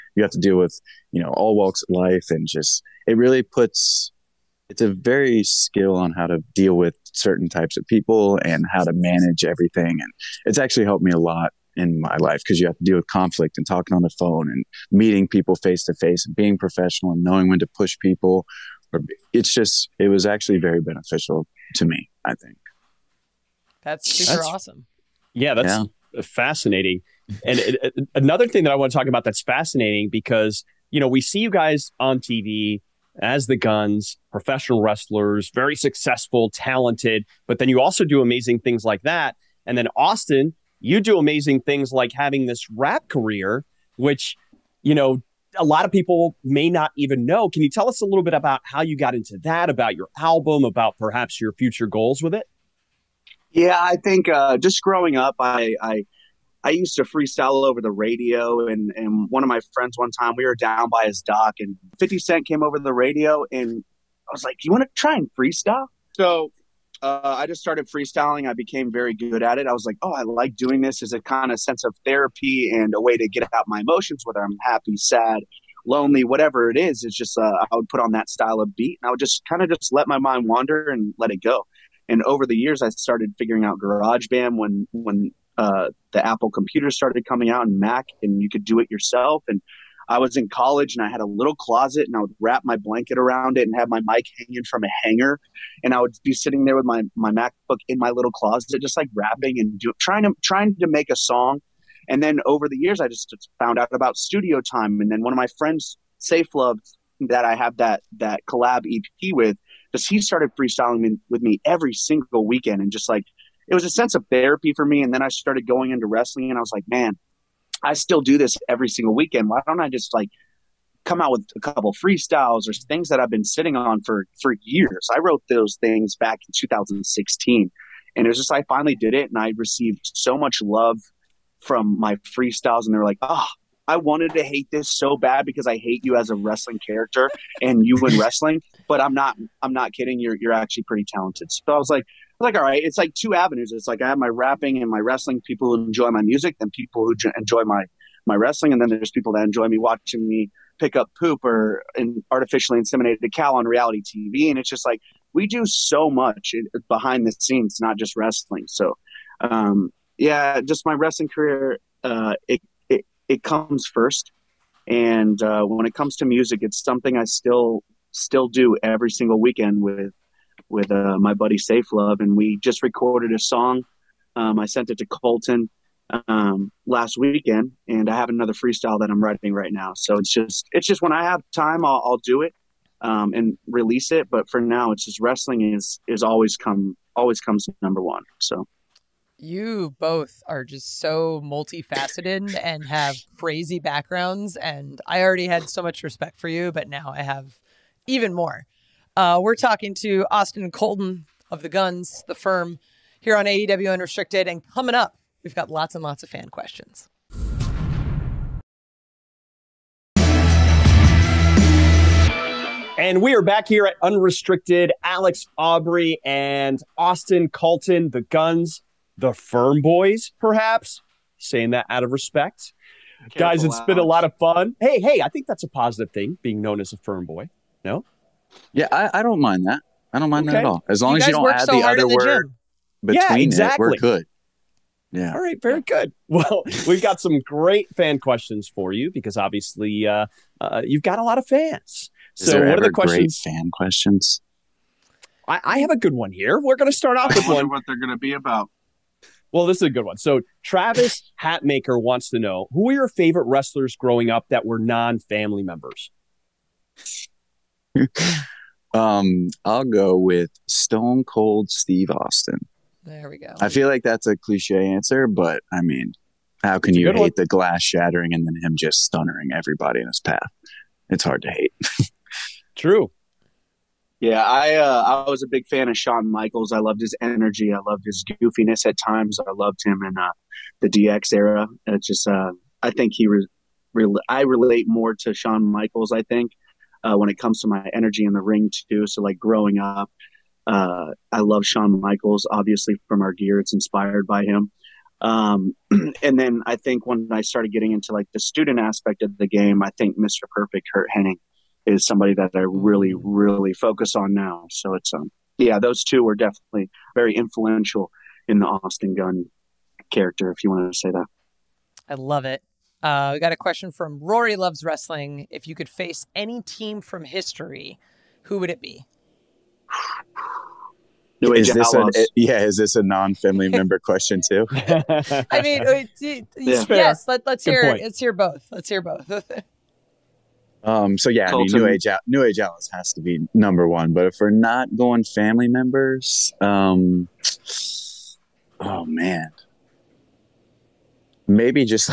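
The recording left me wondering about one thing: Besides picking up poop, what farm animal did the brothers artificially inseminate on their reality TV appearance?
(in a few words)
cow.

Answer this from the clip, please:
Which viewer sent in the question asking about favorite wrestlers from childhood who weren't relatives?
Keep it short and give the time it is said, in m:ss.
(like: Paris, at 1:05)
Travis Hatmaker, at 4:10.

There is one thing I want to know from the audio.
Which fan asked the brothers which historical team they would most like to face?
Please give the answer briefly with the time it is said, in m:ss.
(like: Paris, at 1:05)
Rory Loves Wrestling, at 5:14.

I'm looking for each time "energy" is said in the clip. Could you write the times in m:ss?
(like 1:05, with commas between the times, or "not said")
4:37, 4:47.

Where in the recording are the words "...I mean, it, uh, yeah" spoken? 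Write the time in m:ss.
5:24.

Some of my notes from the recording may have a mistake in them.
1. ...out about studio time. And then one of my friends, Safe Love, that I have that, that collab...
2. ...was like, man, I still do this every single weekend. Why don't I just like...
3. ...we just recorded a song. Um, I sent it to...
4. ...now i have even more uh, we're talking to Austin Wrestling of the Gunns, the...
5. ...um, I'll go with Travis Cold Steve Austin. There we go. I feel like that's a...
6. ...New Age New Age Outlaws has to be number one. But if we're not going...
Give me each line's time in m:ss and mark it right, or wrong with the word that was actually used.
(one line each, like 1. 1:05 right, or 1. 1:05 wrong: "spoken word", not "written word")
1. 1:43 right
2. 1:56 right
3. 2:52 right
4. 3:16 wrong: "Colten", not "Wrestling"
5. 4:18 wrong: "Stone", not "Travis"
6. 5:31 right.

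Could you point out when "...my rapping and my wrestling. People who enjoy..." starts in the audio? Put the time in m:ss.
2:24.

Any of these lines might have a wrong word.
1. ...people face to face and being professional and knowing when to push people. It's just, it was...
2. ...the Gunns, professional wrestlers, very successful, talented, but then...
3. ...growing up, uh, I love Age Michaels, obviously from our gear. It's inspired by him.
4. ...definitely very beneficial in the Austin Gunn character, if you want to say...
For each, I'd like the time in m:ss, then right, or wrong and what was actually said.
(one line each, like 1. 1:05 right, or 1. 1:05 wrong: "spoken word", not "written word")
1. 0:15 right
2. 0:33 right
3. 4:49 wrong: "Shawn", not "Age"
4. 5:06 wrong: "influential", not "beneficial".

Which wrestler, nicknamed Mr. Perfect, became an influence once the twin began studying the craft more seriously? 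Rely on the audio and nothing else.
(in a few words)
Kurt Henning.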